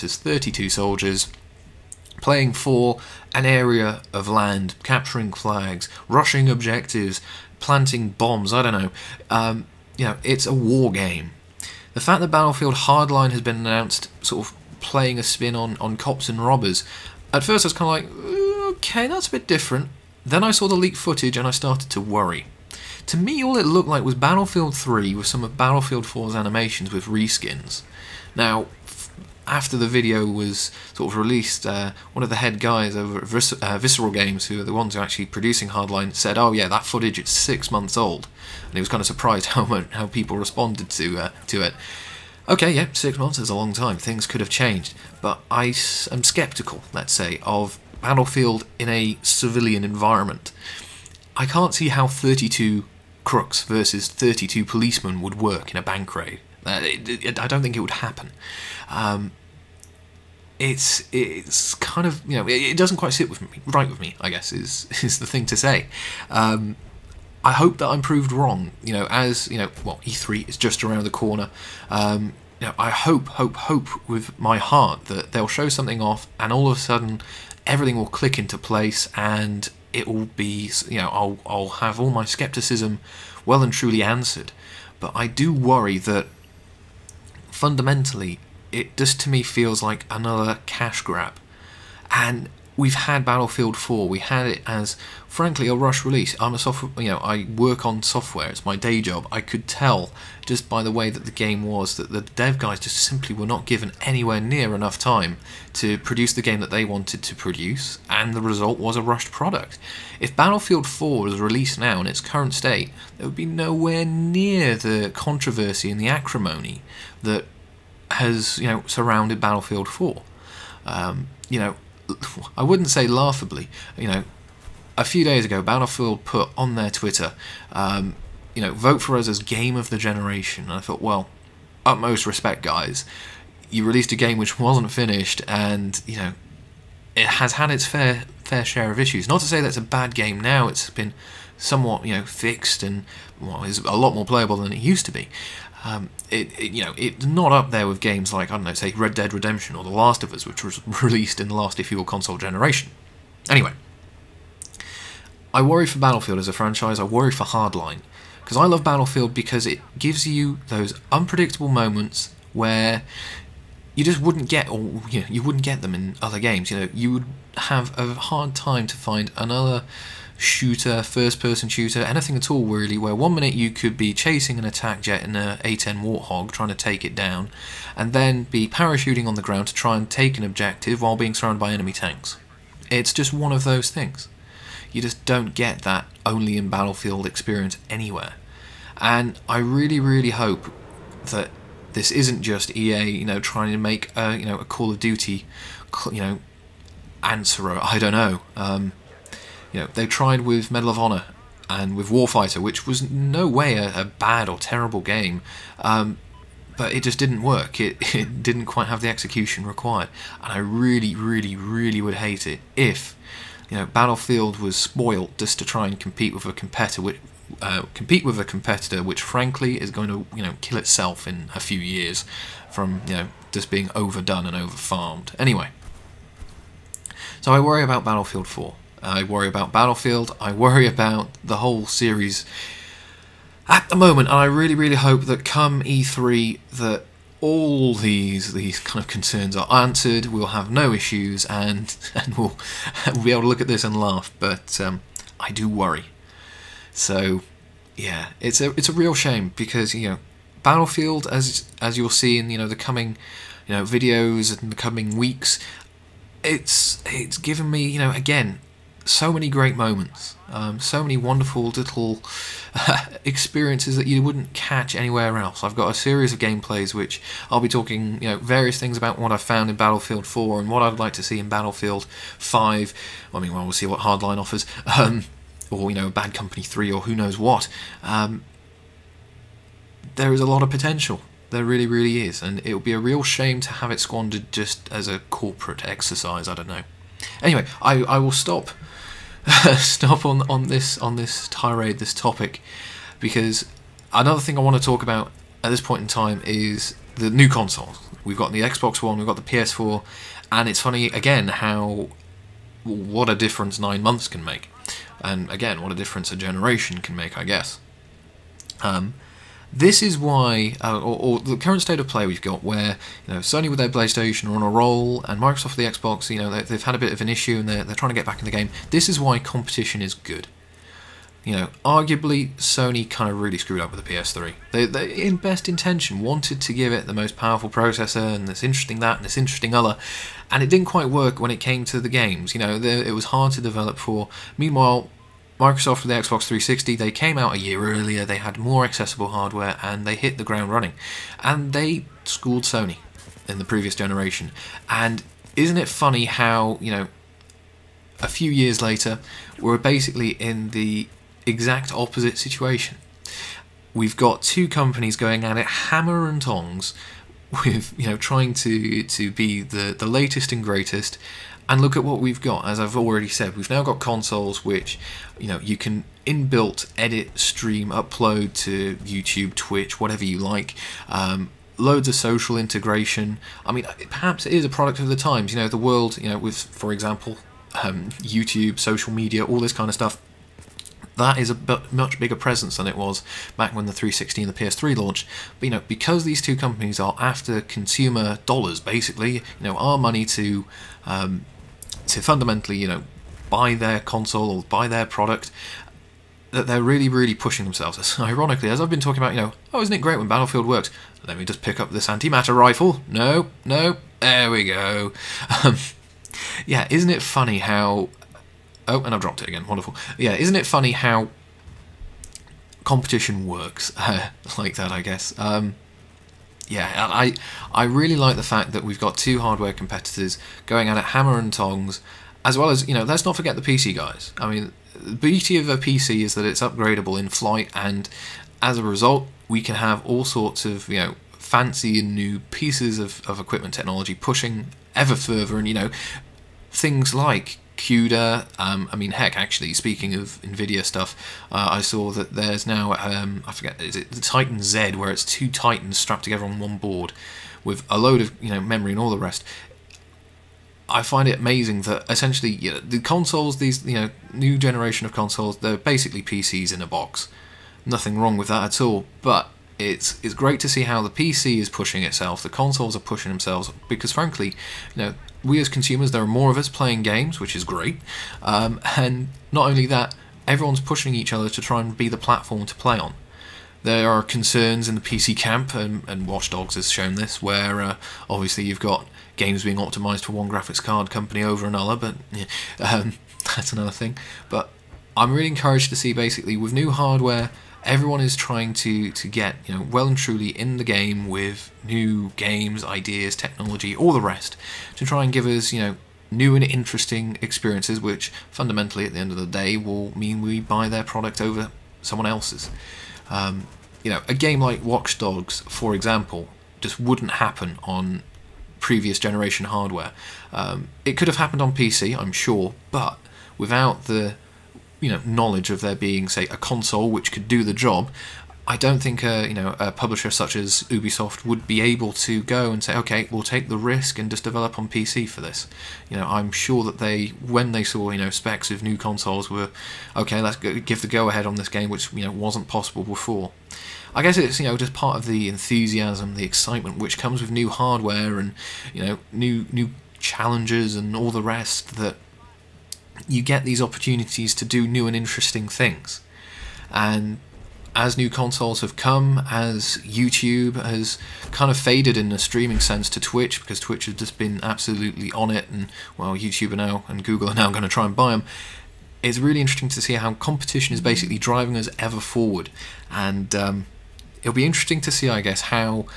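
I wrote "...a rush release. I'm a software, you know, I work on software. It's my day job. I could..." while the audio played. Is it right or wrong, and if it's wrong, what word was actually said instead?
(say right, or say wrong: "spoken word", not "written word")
right.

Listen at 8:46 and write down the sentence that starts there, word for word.
You know, I'm sure that they, when they saw you know specs of new consoles, were okay.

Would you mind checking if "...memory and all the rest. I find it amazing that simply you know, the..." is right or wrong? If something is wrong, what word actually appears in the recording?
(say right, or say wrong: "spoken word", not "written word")
wrong: "essentially", not "simply".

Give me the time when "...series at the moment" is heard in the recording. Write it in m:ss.
3:51.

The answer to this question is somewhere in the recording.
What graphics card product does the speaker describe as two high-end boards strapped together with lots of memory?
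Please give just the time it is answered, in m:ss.
7:24.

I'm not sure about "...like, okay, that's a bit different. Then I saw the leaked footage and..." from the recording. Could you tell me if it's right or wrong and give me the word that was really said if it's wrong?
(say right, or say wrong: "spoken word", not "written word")
right.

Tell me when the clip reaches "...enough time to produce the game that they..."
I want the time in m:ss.
1:44.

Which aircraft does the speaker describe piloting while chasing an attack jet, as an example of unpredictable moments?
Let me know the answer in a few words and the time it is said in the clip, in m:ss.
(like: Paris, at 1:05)
A10 Warthog, at 2:55.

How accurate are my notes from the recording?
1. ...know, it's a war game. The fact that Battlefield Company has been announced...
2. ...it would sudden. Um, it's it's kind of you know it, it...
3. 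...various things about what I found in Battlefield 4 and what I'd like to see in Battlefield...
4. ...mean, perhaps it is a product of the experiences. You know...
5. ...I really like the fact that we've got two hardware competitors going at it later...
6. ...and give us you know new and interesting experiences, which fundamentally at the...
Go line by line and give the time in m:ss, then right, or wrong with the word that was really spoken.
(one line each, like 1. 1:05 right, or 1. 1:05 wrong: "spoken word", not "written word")
1. 0:10 wrong: "Hardline", not "Company"
2. 0:57 wrong: "happen", not "sudden"
3. 4:28 right
4. 6:13 wrong: "times", not "experiences"
5. 6:57 wrong: "hammer", not "later"
6. 8:15 right.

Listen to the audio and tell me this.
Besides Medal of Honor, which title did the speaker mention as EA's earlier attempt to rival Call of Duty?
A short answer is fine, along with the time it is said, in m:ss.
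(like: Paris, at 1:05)
Warfighter, at 3:22.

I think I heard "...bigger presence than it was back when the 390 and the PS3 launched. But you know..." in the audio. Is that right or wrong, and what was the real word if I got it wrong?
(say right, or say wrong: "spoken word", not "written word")
wrong: "360", not "390".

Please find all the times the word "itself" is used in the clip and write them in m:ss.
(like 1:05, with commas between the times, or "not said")
3:40, 7:42.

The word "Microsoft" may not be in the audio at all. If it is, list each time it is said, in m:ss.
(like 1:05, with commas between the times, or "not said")
5:15, 5:35.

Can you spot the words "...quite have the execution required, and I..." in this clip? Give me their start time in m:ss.
3:28.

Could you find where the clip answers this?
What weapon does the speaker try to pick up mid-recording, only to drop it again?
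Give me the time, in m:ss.
6:42.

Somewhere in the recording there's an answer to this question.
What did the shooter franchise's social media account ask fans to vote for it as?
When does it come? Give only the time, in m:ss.
2:09.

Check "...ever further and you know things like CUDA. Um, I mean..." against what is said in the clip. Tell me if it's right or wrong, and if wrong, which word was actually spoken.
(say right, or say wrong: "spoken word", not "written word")
right.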